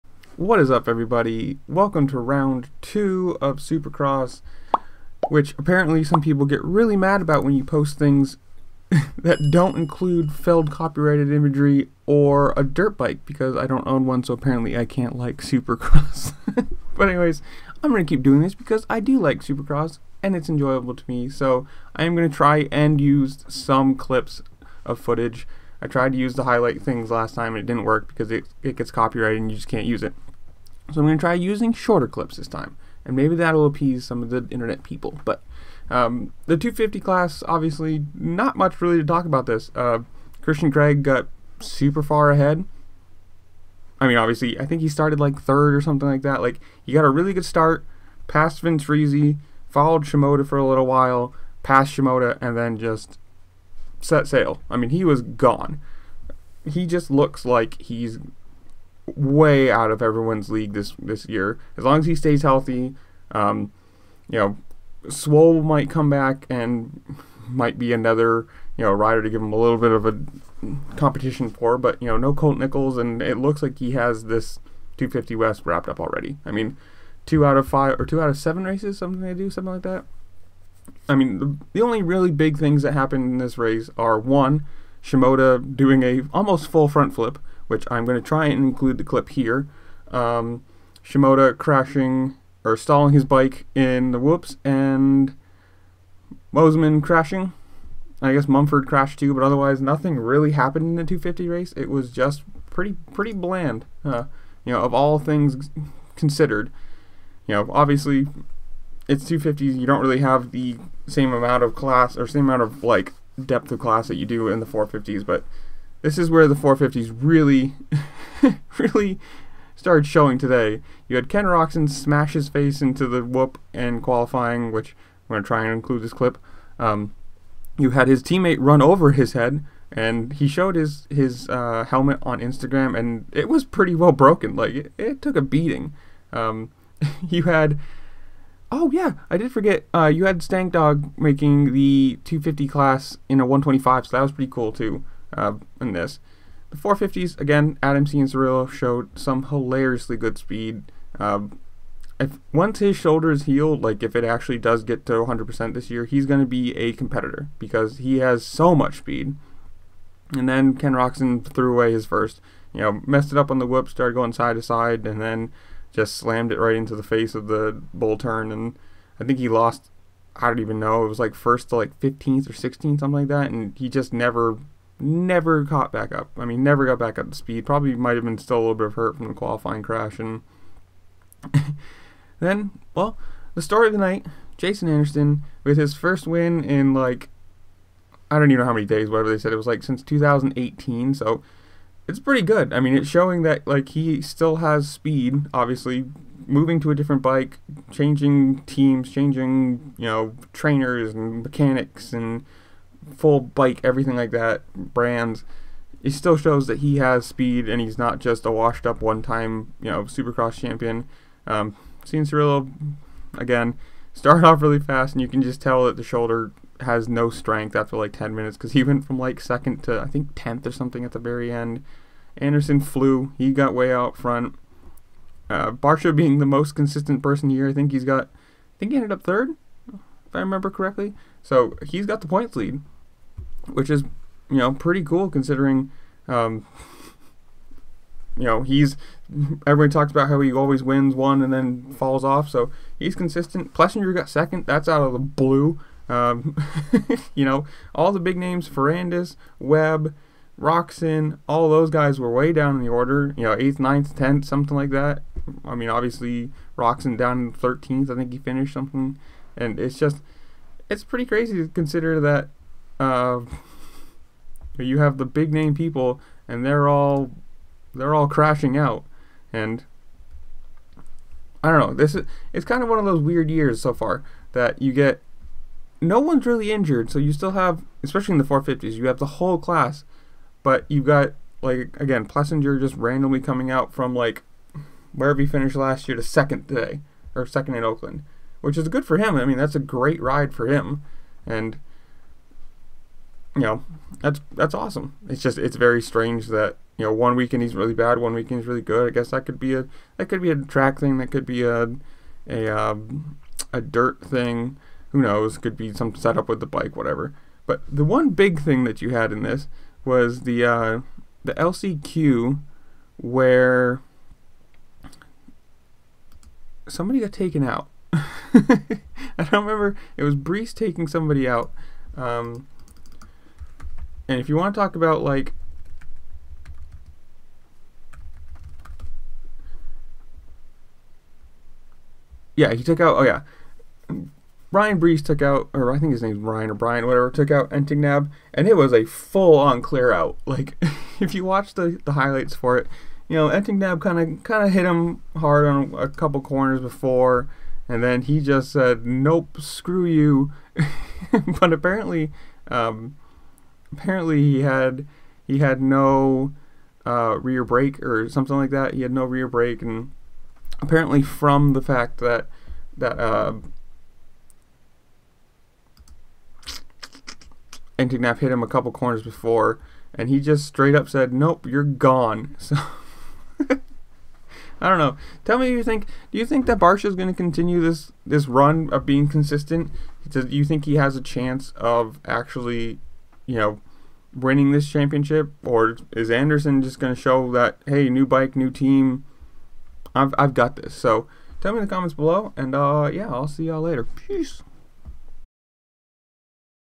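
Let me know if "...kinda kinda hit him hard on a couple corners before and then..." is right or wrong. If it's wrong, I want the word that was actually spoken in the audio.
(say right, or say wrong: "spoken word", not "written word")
right.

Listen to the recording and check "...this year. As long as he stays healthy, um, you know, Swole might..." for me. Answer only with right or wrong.
right.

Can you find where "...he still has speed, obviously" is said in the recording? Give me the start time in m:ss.
3:13.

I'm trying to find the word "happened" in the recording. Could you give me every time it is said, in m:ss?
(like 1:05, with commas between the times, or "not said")
1:22, 1:40.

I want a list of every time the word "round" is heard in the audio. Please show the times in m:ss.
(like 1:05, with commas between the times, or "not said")
0:02.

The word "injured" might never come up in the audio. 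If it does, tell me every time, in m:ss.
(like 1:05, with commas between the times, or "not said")
4:36.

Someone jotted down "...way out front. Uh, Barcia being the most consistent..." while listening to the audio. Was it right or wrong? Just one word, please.
right.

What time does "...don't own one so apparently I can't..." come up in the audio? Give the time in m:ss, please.
0:13.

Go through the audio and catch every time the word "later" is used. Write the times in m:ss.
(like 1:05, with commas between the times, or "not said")
6:33.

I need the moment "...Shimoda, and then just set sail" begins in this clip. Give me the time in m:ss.
0:51.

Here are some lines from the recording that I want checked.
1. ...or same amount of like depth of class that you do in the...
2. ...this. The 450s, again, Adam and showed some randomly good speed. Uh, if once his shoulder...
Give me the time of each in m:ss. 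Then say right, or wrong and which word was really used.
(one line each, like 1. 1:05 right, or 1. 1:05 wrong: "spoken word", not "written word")
1. 1:52 right
2. 2:25 wrong: "hilariously", not "randomly".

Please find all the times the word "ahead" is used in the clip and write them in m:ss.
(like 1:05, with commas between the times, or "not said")
0:42.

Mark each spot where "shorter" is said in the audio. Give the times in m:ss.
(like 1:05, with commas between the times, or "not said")
0:31.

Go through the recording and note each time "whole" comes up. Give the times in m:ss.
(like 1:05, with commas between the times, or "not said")
4:39.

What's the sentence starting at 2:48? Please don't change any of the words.
And I think he lost, I don't even know, it was like first to like 15th or 16th, something like that.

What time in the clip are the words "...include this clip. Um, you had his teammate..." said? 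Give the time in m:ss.
2:05.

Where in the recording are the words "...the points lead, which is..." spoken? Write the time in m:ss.
3:52.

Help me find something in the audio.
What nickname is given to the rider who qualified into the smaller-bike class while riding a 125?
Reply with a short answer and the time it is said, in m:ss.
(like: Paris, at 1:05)
Stank Dog, at 2:20.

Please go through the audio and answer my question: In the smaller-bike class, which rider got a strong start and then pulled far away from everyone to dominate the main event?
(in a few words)
Christian Craig.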